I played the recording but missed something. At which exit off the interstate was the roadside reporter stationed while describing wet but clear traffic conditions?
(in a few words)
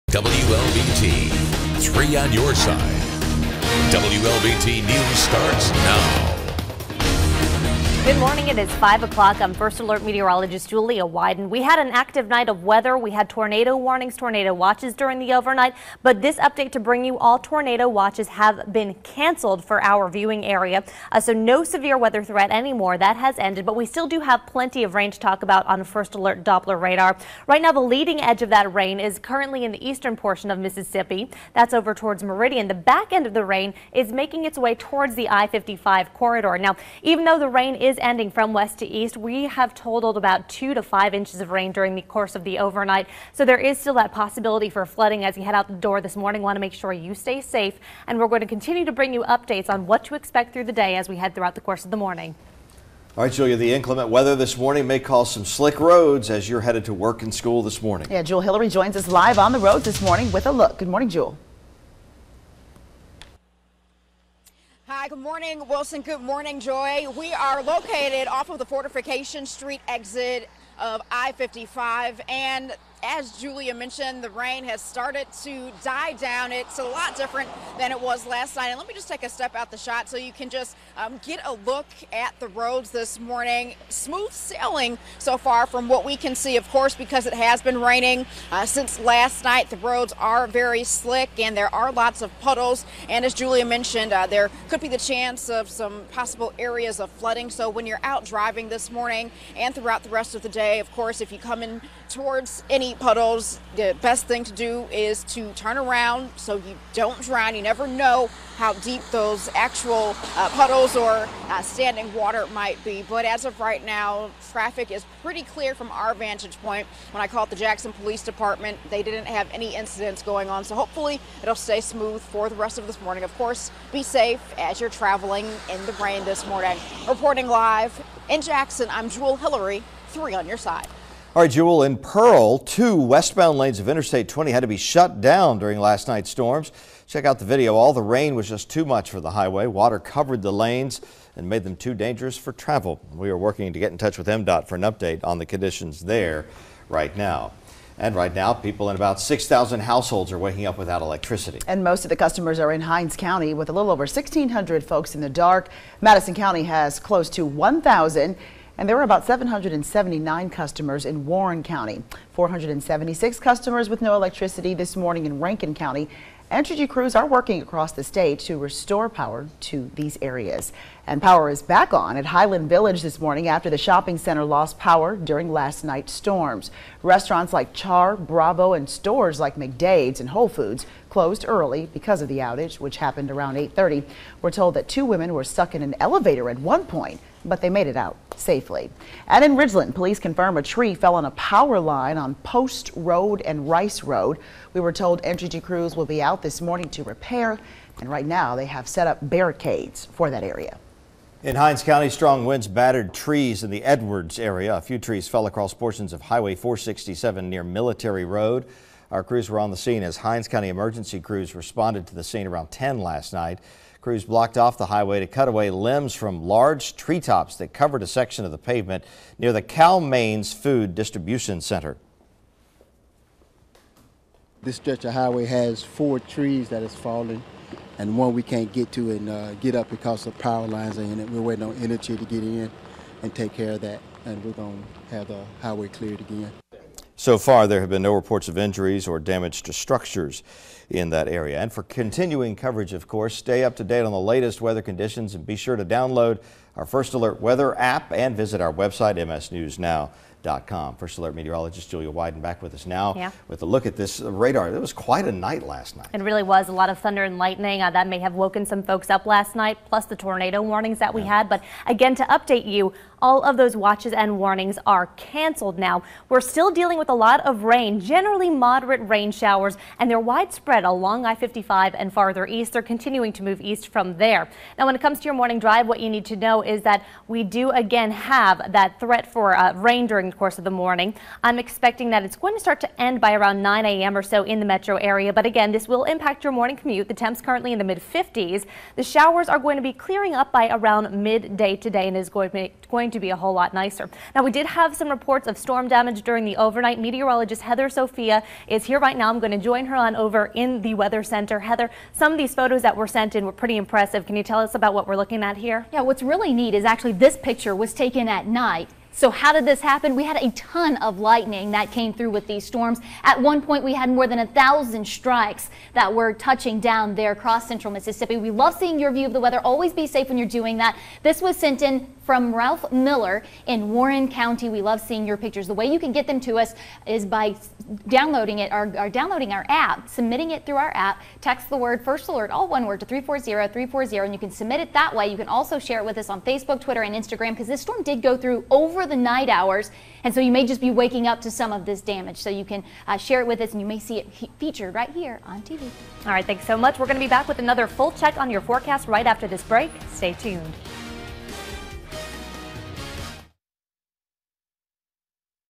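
Fortification Street.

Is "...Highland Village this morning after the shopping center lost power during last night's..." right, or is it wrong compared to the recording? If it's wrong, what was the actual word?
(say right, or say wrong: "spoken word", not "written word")
right.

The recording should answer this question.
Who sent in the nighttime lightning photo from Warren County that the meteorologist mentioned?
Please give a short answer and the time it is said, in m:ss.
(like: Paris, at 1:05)
Ralph Miller, at 5:22.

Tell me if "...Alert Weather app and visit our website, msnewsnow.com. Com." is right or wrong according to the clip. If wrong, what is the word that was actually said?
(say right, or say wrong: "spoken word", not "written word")
right.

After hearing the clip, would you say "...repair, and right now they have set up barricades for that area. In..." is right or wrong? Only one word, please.
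right.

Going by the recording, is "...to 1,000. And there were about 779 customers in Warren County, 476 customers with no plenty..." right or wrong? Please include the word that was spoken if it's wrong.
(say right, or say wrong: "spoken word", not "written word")
wrong: "electricity", not "plenty".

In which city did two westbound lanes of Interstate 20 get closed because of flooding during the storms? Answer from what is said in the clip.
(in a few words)
Pearl.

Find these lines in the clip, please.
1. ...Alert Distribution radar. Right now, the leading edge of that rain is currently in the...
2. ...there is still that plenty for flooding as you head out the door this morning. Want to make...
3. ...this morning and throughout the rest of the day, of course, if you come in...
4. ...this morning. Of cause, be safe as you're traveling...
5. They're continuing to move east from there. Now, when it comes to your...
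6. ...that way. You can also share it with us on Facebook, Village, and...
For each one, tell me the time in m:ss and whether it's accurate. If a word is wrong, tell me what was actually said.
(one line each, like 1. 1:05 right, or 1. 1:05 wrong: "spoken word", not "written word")
1. 0:26 wrong: "Doppler", not "Distribution"
2. 0:43 wrong: "possibility", not "plenty"
3. 1:38 right
4. 2:02 wrong: "course", not "cause"
5. 4:32 right
6. 5:34 wrong: "Twitter", not "Village".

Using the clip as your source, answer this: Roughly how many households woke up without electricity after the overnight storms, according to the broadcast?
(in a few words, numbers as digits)
6,000.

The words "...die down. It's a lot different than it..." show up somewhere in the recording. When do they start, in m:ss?
1:15.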